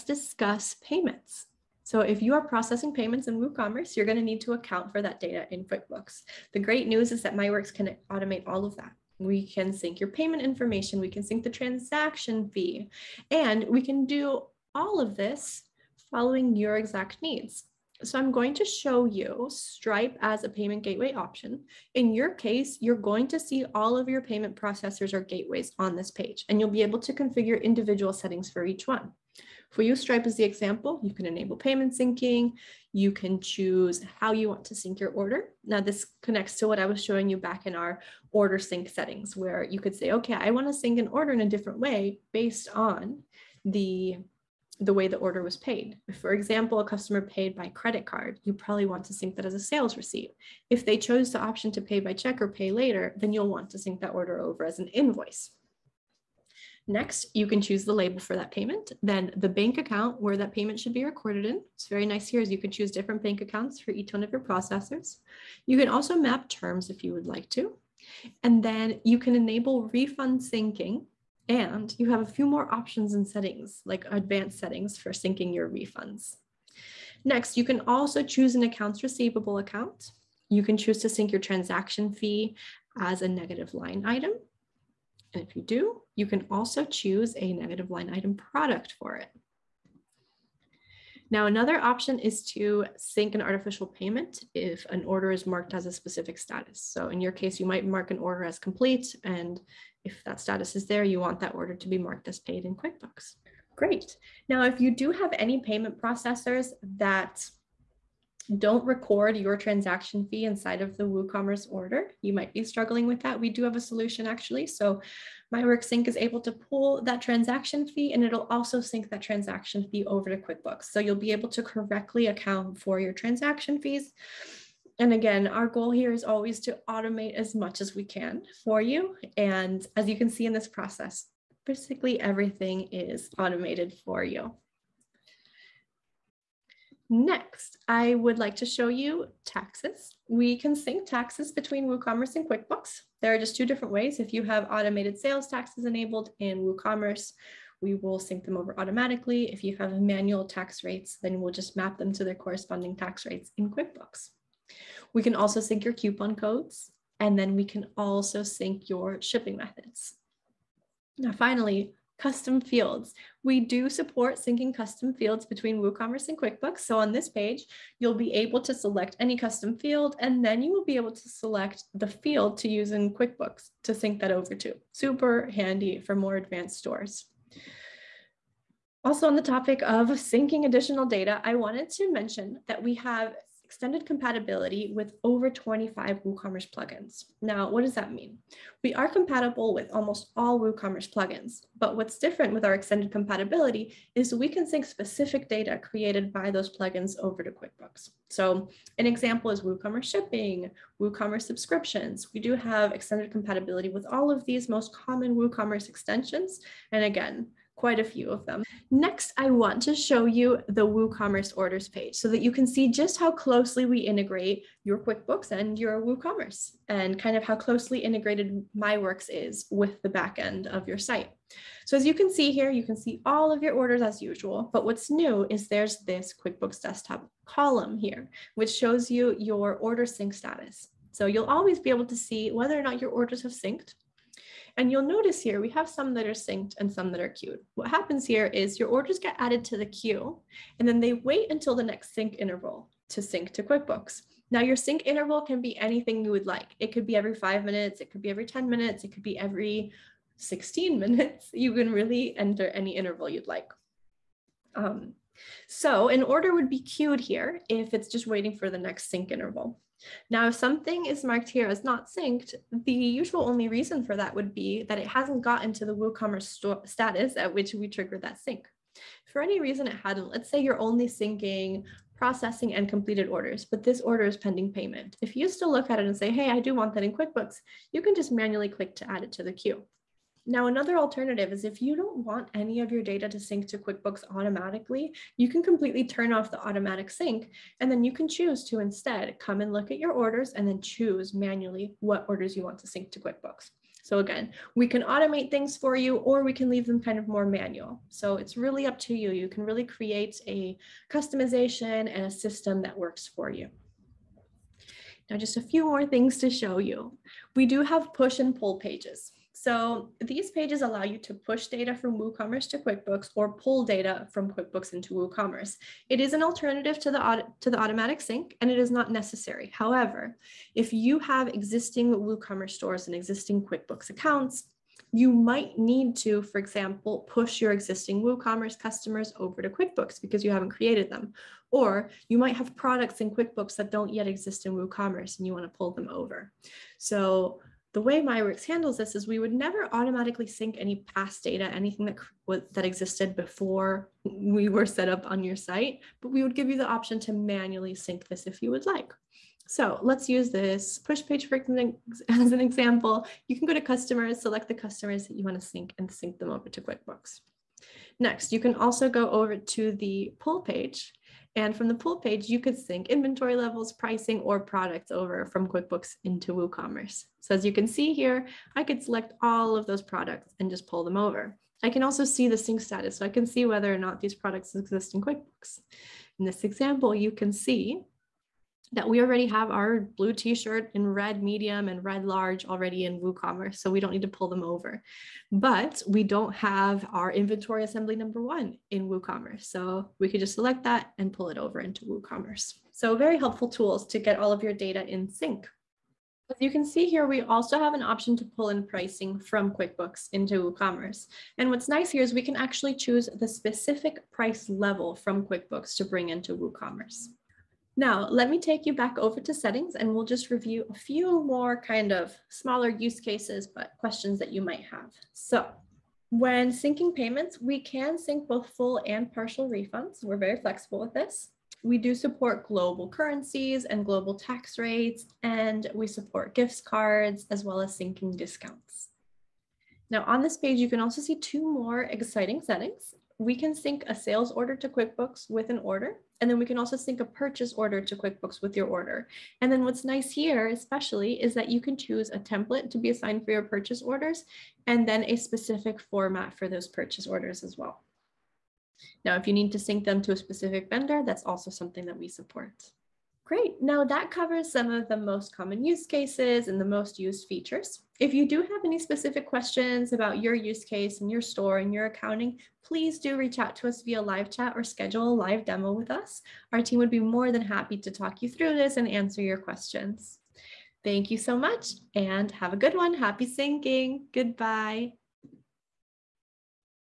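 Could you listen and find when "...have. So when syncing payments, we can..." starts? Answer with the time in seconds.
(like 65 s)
414 s.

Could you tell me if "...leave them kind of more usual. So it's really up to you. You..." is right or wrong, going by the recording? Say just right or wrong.
wrong.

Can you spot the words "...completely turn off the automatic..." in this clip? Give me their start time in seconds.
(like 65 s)
285 s.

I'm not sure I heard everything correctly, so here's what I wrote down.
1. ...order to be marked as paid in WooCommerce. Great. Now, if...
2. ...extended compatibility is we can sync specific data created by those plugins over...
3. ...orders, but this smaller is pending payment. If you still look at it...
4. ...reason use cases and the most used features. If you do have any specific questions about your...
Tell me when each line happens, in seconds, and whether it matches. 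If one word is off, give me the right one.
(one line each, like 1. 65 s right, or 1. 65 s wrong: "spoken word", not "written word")
1. 101 s wrong: "QuickBooks", not "WooCommerce"
2. 192 s right
3. 273 s wrong: "order", not "smaller"
4. 455 s wrong: "common", not "reason".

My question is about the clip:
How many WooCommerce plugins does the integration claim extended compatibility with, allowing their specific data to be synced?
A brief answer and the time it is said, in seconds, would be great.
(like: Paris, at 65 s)
Over 25, at 185 s.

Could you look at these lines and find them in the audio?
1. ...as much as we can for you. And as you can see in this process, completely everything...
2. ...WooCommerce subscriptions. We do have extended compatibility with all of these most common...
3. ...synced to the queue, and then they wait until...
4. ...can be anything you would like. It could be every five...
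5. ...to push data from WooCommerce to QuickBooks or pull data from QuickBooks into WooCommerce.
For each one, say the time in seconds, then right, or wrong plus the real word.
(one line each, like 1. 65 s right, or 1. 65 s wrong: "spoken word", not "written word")
1. 127 s wrong: "basically", not "completely"
2. 200 s right
3. 239 s wrong: "added", not "synced"
4. 245 s right
5. 311 s right.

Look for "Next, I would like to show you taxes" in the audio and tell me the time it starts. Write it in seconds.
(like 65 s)
137 s.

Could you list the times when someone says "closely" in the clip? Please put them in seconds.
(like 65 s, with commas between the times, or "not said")
213 s, 217 s.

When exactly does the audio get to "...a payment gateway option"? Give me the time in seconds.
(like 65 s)
20 s.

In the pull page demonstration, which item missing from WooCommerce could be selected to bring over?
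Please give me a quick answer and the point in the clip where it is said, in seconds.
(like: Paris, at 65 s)
Inventory assembly number one, at 387 s.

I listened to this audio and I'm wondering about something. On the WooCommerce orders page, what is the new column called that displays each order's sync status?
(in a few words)
QuickBooks Desktop.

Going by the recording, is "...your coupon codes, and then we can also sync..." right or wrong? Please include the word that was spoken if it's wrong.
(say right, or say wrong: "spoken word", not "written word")
right.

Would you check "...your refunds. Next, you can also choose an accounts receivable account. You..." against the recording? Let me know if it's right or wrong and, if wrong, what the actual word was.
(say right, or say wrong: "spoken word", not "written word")
right.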